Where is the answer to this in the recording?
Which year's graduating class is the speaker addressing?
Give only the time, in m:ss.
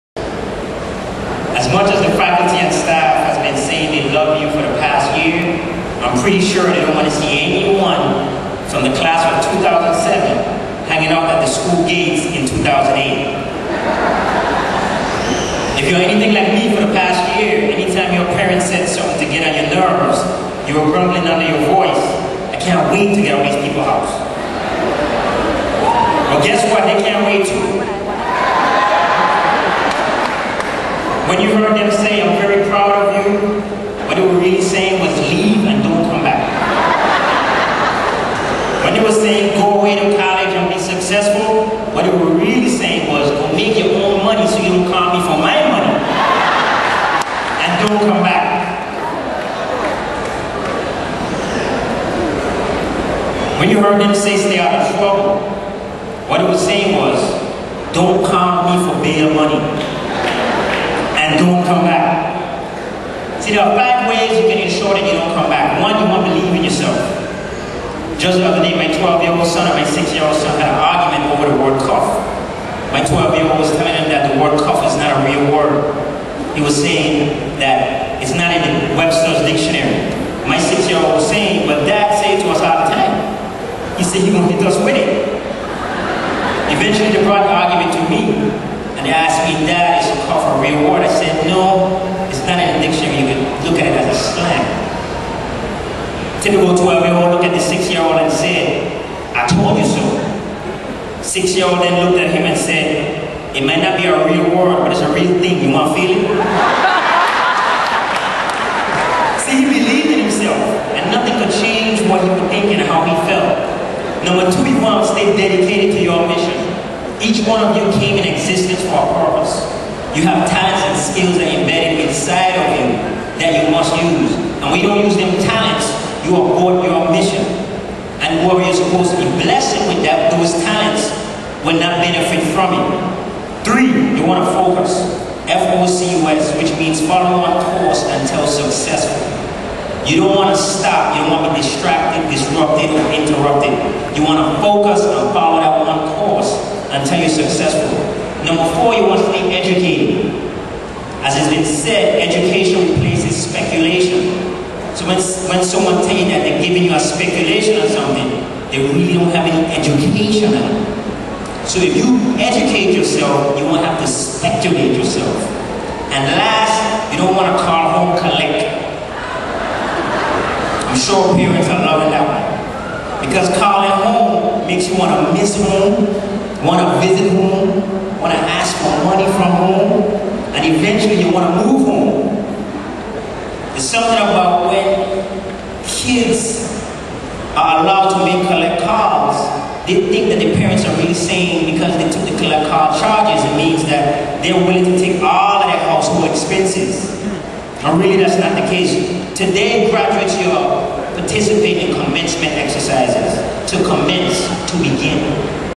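0:09.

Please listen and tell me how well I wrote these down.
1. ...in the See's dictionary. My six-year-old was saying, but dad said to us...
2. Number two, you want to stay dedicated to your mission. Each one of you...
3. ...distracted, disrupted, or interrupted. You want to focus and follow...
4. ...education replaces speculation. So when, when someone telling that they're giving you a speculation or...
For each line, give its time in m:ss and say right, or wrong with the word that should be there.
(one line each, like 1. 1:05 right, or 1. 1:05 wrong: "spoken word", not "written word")
1. 1:18 wrong: "Webster", not "See"
2. 1:54 right
3. 2:21 right
4. 2:32 right.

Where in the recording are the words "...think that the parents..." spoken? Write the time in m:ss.
3:10.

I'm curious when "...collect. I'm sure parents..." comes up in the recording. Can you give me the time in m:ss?
2:48.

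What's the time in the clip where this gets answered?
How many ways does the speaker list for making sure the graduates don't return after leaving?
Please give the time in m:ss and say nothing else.
1:03.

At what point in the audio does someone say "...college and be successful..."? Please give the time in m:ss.
0:40.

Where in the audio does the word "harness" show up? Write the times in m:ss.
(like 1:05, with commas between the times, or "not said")
not said.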